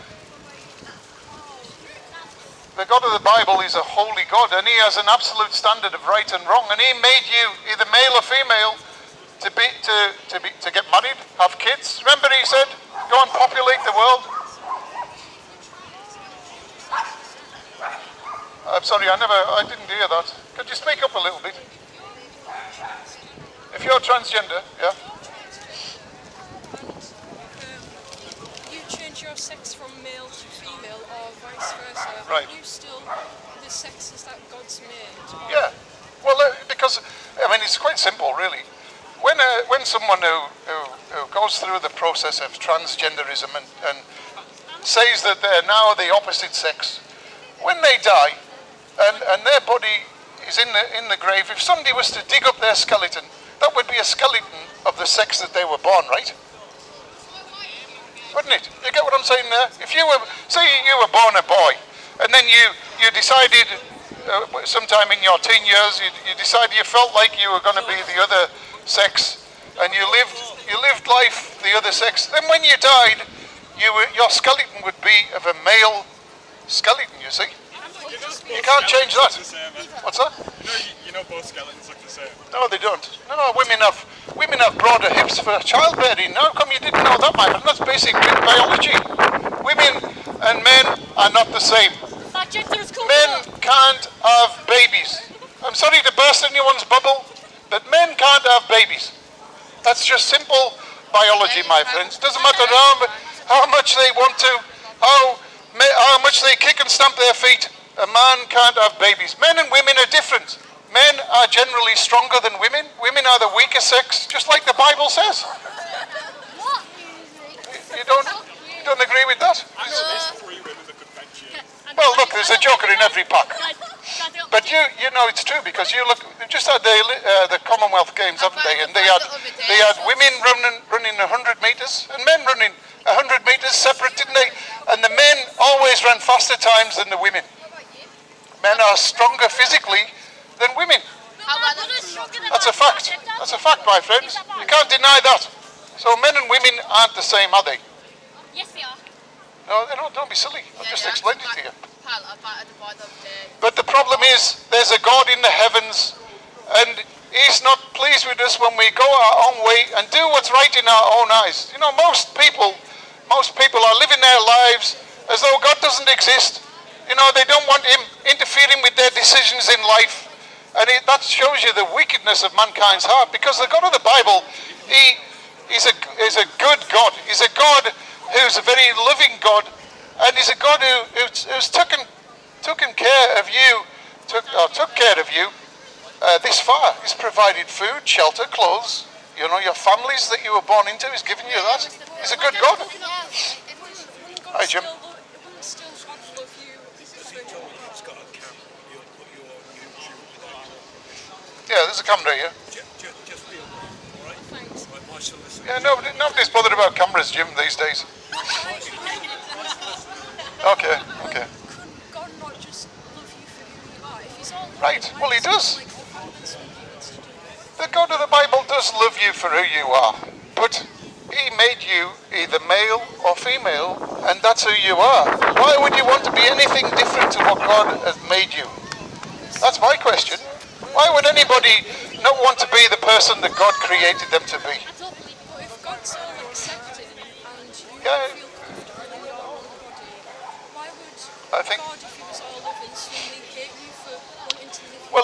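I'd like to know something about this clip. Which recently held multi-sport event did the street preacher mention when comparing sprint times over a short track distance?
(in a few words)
Commonwealth Games.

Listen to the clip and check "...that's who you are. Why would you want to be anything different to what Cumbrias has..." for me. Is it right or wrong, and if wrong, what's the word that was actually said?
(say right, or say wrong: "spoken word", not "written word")
wrong: "God", not "Cumbrias".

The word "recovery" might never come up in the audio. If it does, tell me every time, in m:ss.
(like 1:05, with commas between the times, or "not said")
not said.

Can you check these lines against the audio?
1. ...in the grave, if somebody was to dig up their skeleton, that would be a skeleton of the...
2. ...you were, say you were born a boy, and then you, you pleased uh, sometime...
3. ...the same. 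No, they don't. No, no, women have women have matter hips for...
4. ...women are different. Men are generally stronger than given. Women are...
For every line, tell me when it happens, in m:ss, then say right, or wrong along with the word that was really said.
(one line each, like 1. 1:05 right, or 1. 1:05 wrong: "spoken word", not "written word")
1. 0:50 right
2. 0:59 wrong: "decided", not "pleased"
3. 1:21 wrong: "broader", not "matter"
4. 1:49 wrong: "women", not "given".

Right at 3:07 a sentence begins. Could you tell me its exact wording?
He's provided food, shelter, clothes, you know, your families that you were born into.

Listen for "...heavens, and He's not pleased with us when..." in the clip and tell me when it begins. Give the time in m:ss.
2:35.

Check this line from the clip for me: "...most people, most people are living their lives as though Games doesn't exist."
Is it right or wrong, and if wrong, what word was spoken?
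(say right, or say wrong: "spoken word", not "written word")
wrong: "God", not "Games".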